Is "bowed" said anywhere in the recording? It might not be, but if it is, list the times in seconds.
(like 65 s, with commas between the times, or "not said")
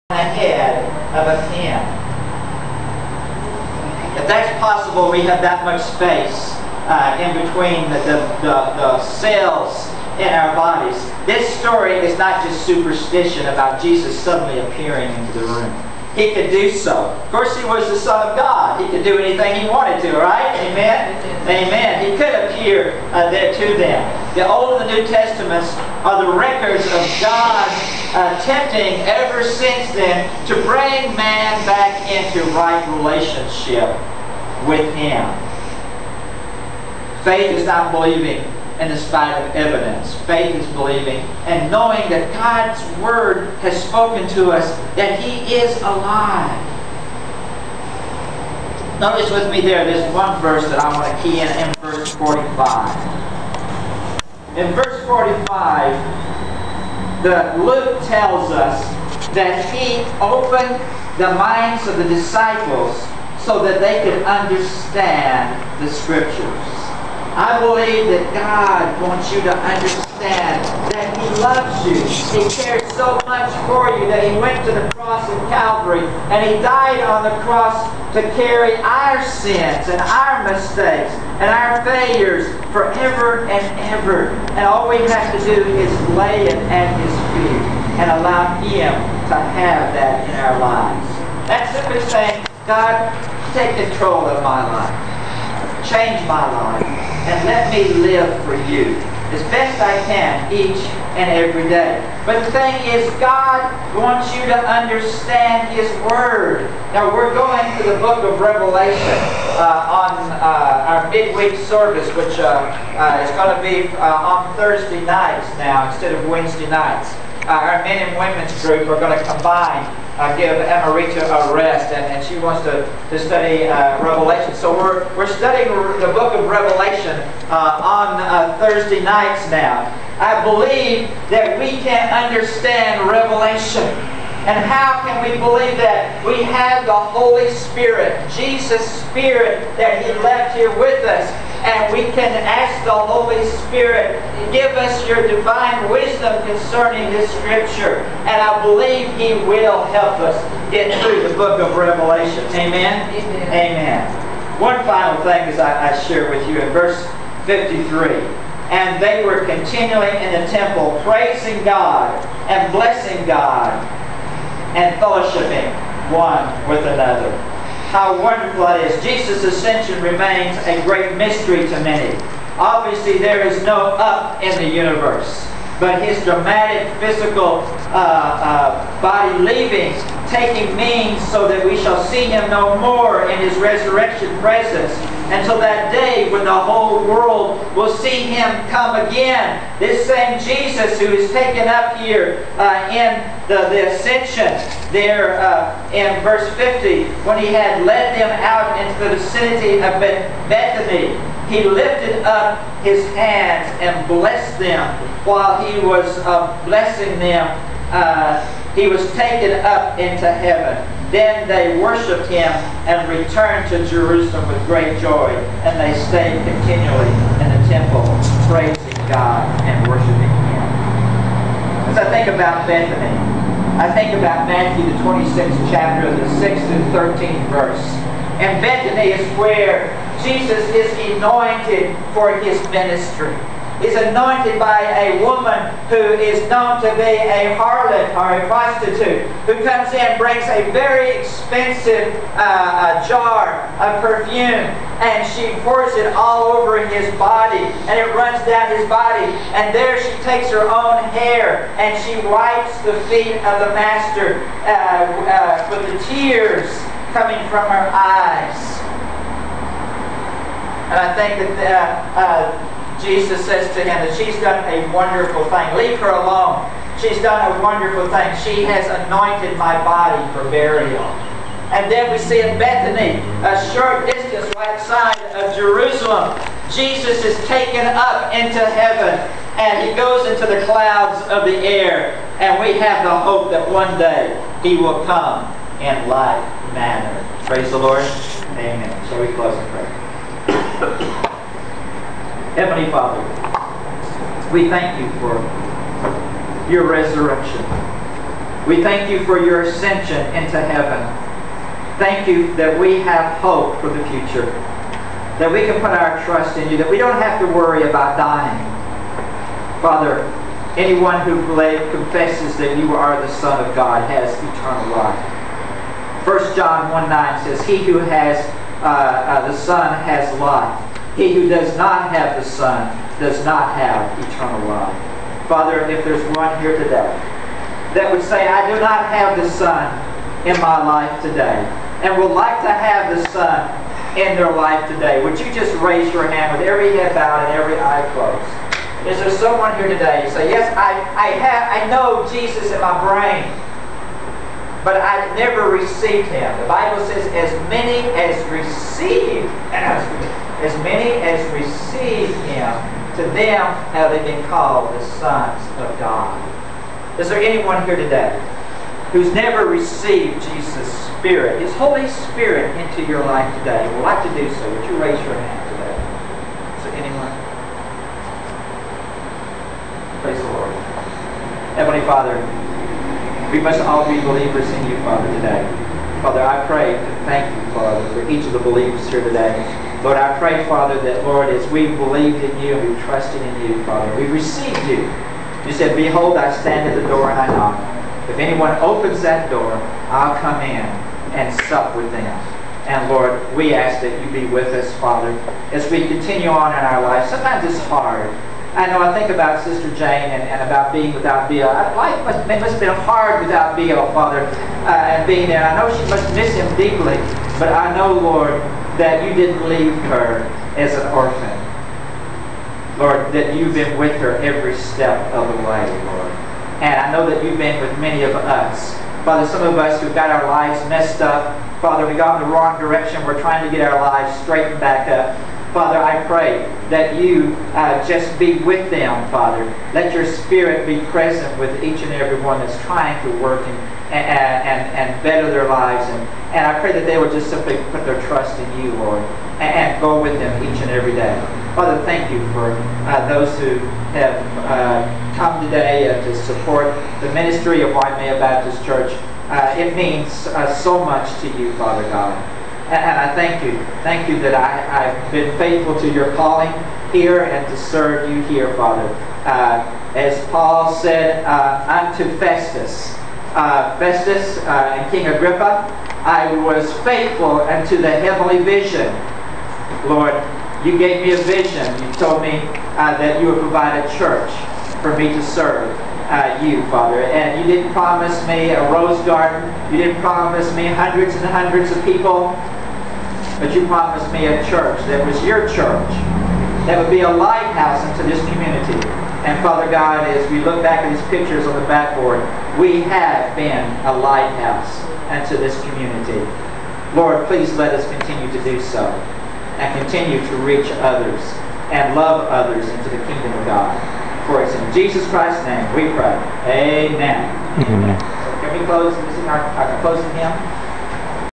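337 s.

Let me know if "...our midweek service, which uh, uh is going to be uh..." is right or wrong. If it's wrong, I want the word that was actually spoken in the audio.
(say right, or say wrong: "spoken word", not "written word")
right.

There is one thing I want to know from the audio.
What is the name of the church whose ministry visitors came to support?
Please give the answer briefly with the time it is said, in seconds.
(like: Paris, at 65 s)
Waimea Baptist Church, at 447 s.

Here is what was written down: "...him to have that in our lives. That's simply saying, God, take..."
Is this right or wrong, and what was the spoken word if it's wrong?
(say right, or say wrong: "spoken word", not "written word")
right.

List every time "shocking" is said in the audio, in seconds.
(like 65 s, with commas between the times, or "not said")
not said.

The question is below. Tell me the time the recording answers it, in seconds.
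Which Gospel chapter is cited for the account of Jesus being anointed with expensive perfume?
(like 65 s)
224 s.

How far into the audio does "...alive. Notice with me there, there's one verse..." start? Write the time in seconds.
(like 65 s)
45 s.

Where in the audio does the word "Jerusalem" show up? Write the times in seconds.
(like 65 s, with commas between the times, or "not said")
213 s, 275 s.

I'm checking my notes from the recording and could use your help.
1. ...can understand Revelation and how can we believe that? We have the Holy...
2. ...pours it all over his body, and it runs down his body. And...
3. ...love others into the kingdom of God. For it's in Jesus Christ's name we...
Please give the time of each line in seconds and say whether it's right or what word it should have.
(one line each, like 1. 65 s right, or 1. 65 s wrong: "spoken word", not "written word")
1. 131 s right
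2. 245 s right
3. 502 s right.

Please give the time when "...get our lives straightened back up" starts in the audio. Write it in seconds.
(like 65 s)
423 s.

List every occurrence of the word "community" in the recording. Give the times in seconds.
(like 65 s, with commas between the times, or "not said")
488 s, 495 s.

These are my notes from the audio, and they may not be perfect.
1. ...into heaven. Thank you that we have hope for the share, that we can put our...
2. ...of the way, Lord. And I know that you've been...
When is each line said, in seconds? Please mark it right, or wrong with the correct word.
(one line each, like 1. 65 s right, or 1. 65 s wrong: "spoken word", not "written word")
1. 300 s wrong: "future", not "share"
2. 415 s right.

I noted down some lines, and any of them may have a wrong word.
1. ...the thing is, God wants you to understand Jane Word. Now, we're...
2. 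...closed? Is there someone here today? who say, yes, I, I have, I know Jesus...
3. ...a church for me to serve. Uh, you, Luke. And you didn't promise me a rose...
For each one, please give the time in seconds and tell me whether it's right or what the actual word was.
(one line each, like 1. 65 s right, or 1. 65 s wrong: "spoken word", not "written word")
1. 102 s wrong: "His", not "Jane"
2. 338 s right
3. 474 s wrong: "Father", not "Luke".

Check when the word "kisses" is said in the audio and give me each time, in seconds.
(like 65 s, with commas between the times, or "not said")
not said.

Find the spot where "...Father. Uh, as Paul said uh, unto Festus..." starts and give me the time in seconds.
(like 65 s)
458 s.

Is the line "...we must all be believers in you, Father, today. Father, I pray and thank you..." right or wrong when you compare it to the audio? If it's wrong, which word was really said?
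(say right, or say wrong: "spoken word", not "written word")
right.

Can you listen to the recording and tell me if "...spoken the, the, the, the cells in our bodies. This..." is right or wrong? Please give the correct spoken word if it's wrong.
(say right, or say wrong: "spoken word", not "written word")
wrong: "between", not "spoken".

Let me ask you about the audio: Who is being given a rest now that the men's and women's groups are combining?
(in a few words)
Amarita.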